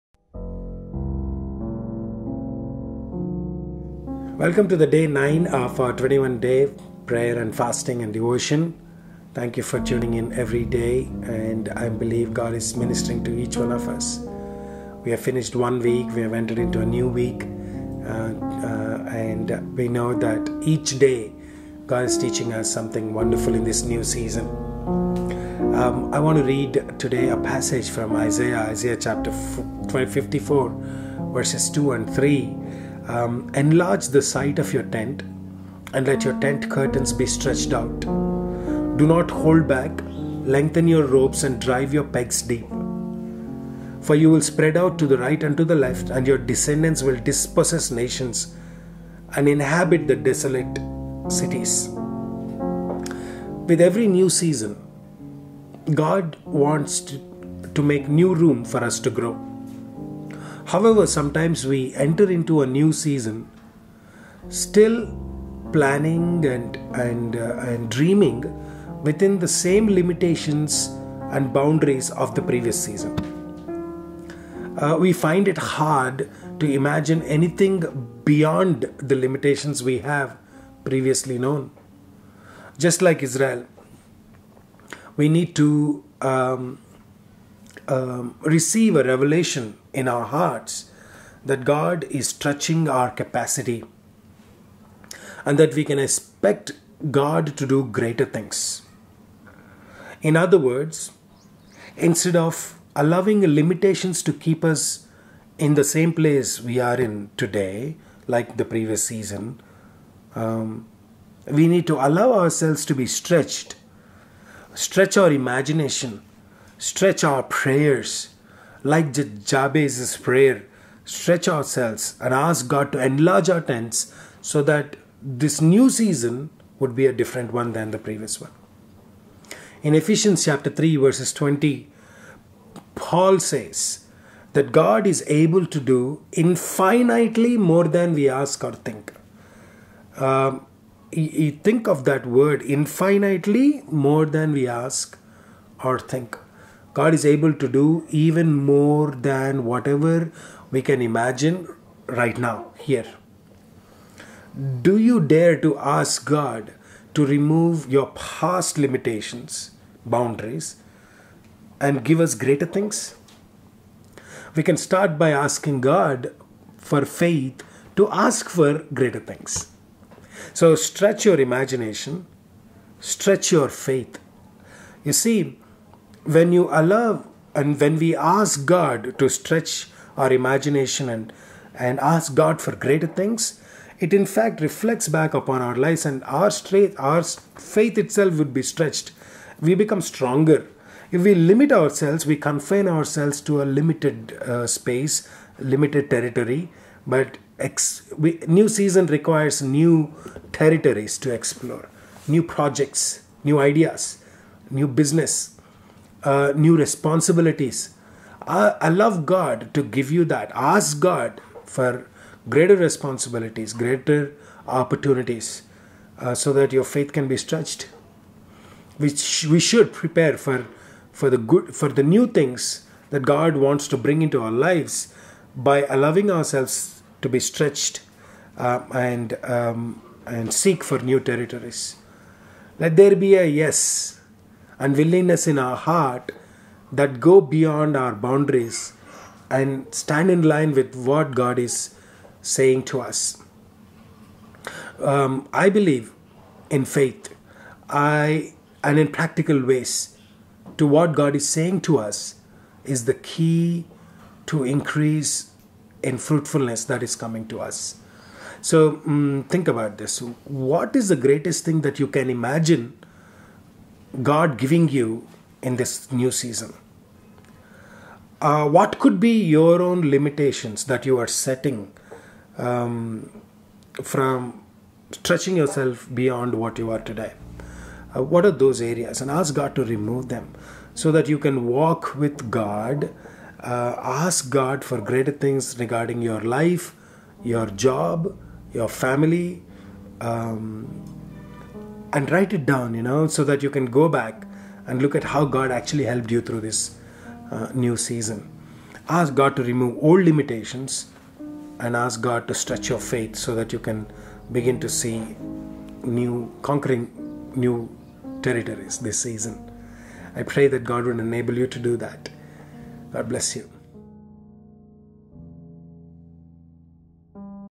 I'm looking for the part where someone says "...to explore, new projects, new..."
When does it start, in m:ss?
3:21.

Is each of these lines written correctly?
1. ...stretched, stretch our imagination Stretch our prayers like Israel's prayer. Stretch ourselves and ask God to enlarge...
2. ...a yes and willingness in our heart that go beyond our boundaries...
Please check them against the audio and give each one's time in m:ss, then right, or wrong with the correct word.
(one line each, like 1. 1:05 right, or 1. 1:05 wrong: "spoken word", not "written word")
1. 1:53 wrong: "Jabez", not "Israel"
2. 3:53 right.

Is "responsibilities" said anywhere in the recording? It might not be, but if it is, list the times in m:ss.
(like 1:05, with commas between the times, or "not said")
3:26, 3:32.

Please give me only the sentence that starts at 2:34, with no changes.
Do you dare to ask God to remove your past limitations, boundaries, and give us greater things?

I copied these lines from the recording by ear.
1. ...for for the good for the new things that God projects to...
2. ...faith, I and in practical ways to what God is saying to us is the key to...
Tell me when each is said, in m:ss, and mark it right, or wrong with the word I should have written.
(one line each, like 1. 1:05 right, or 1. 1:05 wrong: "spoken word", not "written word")
1. 3:40 wrong: "wants", not "projects"
2. 4:06 right.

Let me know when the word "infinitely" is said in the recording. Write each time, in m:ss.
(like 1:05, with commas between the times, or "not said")
2:16, 2:22.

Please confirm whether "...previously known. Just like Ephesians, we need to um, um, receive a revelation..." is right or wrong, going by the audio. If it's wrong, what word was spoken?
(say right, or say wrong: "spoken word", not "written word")
wrong: "Israel", not "Ephesians".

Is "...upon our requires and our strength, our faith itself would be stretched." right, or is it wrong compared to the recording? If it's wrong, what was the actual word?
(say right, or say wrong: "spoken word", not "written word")
wrong: "lives", not "requires".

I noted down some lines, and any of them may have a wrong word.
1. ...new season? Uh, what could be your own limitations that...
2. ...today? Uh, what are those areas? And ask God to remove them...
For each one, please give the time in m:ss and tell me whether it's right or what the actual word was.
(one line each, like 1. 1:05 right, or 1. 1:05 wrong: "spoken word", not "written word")
1. 4:26 right
2. 4:36 right.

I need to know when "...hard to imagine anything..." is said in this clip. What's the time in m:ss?
1:15.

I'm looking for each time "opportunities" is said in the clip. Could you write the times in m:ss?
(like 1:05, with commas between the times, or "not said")
3:34.